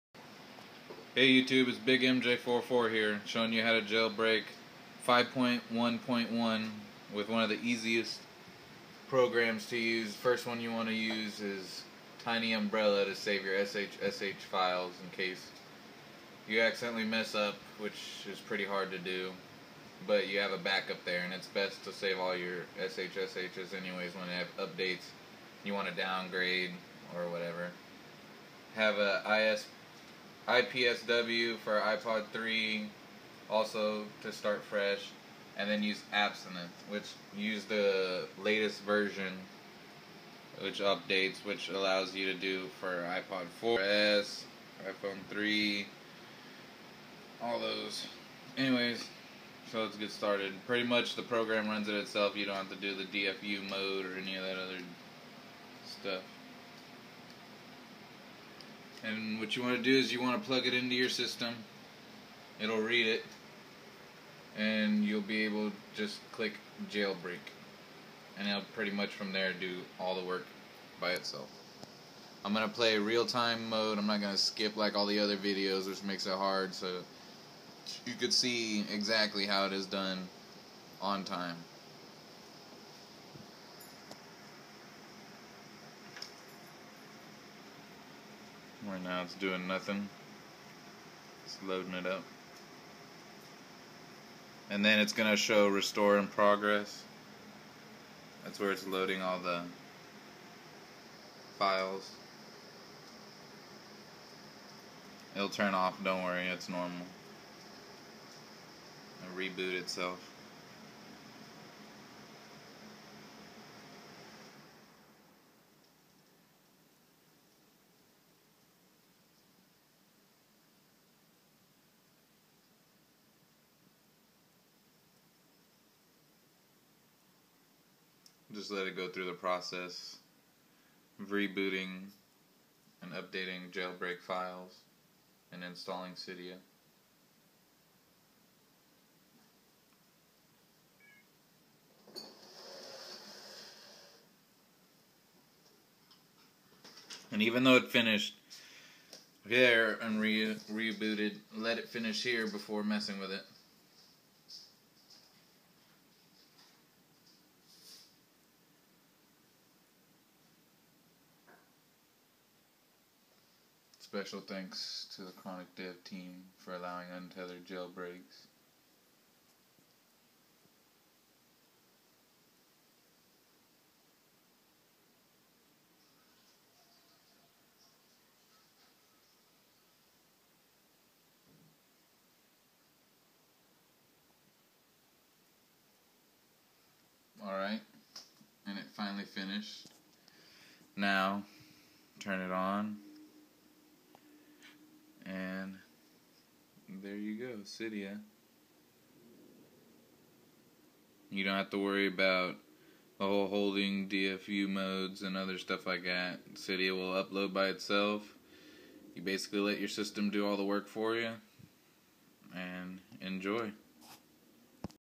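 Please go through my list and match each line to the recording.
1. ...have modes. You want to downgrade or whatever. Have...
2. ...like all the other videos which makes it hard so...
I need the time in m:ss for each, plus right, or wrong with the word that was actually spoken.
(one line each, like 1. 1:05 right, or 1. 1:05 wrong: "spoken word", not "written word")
1. 0:24 wrong: "updates", not "modes"
2. 1:14 right.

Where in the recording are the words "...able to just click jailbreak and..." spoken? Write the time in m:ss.
1:05.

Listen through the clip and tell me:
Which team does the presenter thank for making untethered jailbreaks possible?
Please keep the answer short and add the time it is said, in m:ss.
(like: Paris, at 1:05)
Chronic Dev team, at 2:45.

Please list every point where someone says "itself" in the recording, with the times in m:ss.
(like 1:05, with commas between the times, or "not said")
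0:51, 1:11, 1:49, 3:27.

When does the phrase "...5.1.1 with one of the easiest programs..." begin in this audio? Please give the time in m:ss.
0:05.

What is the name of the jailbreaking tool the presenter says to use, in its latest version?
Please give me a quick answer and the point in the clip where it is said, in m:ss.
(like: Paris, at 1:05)
Absinthe, at 0:36.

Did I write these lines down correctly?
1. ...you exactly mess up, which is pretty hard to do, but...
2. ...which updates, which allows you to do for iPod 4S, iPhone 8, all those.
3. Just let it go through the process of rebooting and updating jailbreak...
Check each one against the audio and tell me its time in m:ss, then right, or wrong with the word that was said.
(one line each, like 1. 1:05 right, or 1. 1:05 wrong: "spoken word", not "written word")
1. 0:16 wrong: "accidentally", not "exactly"
2. 0:40 wrong: "3", not "8"
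3. 2:08 right.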